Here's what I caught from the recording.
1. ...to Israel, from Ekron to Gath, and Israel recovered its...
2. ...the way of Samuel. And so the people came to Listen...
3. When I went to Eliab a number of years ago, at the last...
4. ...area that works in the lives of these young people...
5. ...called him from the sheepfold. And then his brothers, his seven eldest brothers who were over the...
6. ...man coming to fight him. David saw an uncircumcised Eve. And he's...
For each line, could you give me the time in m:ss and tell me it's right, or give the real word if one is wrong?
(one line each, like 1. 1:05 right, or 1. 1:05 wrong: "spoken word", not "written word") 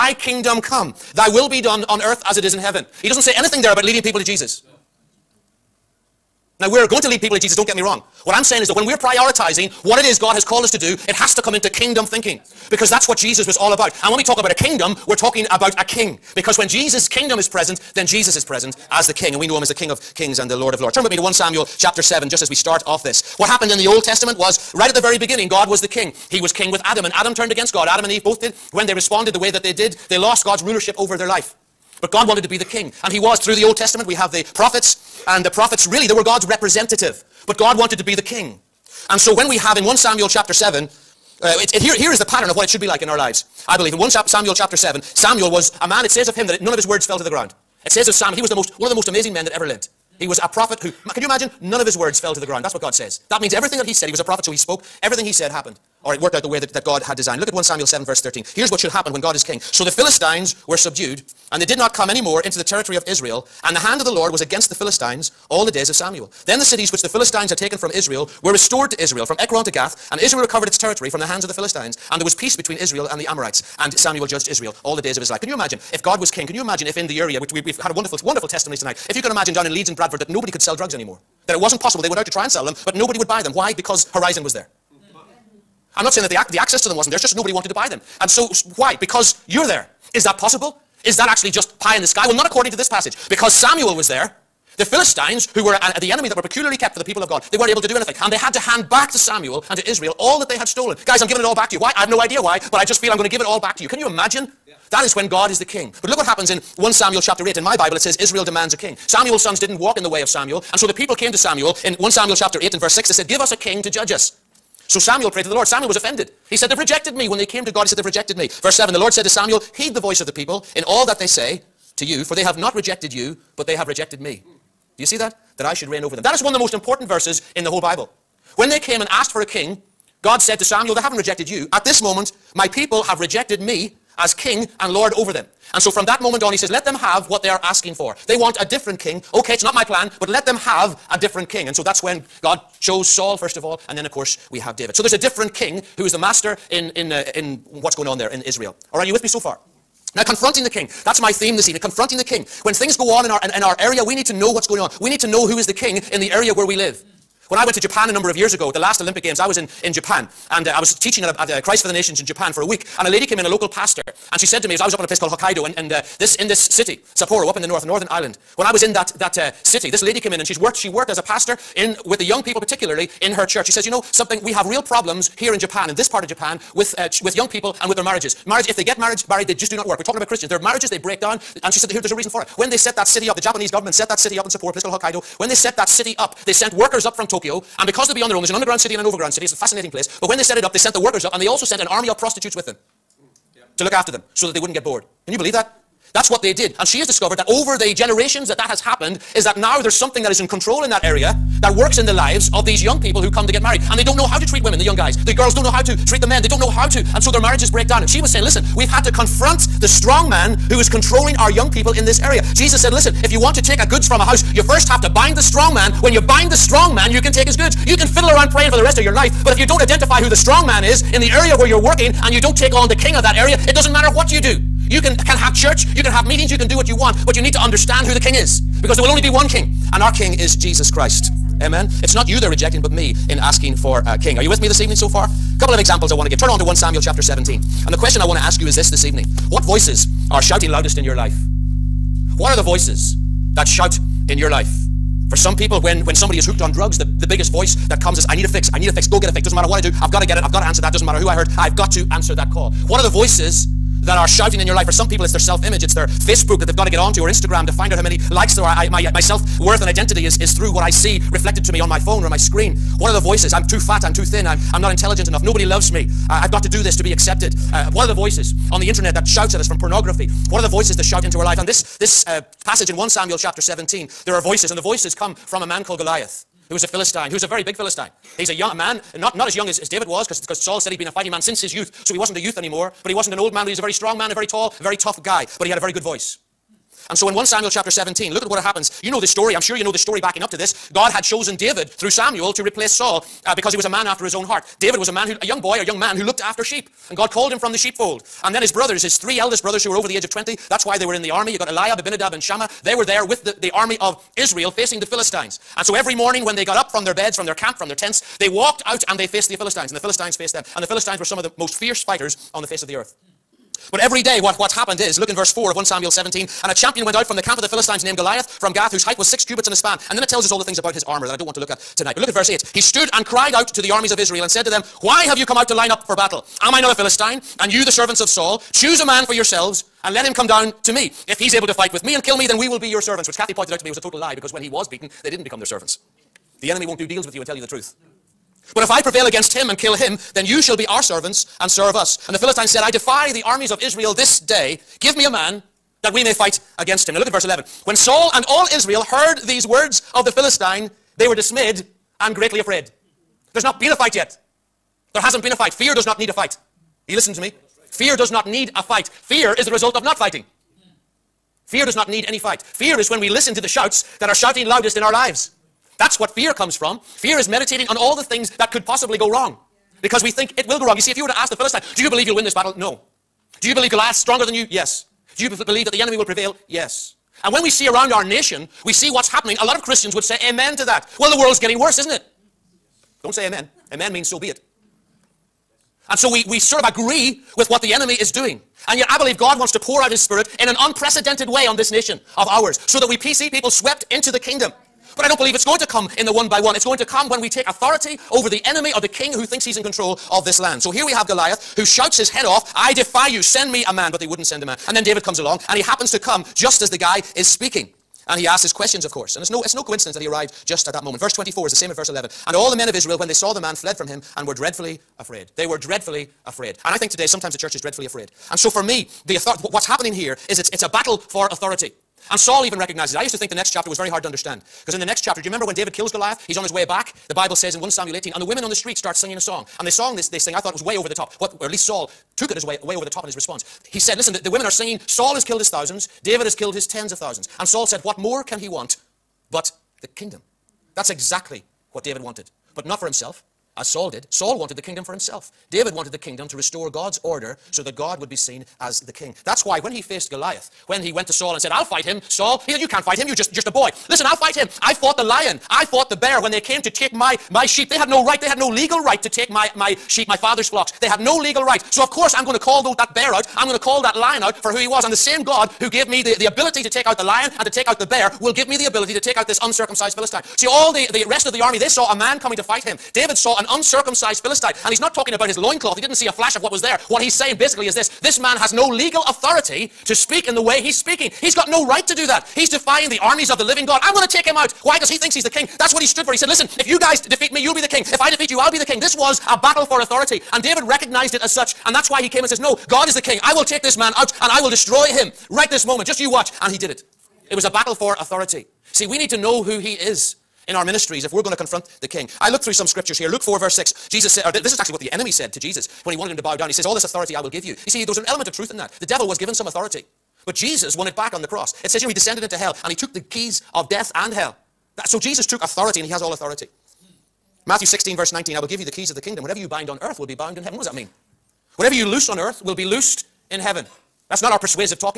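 1. 1:08 right
2. 1:50 wrong: "Samuel", not "Listen"
3. 2:37 wrong: "Japan", not "Eliab"
4. 3:21 right
5. 4:57 wrong: "three", not "seven"
6. 7:52 wrong: "Philistine", not "Eve".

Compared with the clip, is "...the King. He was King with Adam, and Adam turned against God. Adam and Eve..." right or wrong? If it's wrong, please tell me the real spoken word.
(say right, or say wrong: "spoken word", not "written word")
right.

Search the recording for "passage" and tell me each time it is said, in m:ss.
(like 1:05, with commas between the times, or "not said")
1:32, 4:32.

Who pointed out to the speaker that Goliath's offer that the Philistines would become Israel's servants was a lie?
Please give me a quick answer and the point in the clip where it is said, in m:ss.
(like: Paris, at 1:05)
Kathy, at 5:33.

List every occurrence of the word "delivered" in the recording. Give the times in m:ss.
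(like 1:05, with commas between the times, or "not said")
not said.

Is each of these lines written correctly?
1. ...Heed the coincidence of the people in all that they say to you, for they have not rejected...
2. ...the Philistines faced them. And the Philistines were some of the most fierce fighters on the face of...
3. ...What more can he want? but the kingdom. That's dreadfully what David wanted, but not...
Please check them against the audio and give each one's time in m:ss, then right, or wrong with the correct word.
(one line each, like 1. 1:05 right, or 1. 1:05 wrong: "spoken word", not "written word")
1. 1:59 wrong: "voice", not "coincidence"
2. 5:09 right
3. 7:18 wrong: "exactly", not "dreadfully".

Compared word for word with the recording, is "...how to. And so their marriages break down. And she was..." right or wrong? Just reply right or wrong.
right.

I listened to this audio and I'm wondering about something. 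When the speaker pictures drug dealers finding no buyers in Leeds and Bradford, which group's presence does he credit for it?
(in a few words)
Horizon.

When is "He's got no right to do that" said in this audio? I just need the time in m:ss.
8:01.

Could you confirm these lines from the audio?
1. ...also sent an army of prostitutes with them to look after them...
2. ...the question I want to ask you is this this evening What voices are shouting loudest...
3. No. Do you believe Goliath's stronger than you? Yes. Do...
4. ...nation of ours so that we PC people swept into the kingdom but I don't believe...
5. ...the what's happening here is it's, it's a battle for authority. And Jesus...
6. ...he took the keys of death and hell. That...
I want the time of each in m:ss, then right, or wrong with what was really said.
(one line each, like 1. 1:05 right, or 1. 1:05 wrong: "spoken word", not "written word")
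1. 3:11 right
2. 3:57 right
3. 6:12 right
4. 6:31 right
5. 6:59 wrong: "Saul", not "Jesus"
6. 8:32 right.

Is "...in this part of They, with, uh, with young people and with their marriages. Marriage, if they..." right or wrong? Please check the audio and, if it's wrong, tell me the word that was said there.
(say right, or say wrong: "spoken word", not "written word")
wrong: "Japan", not "They".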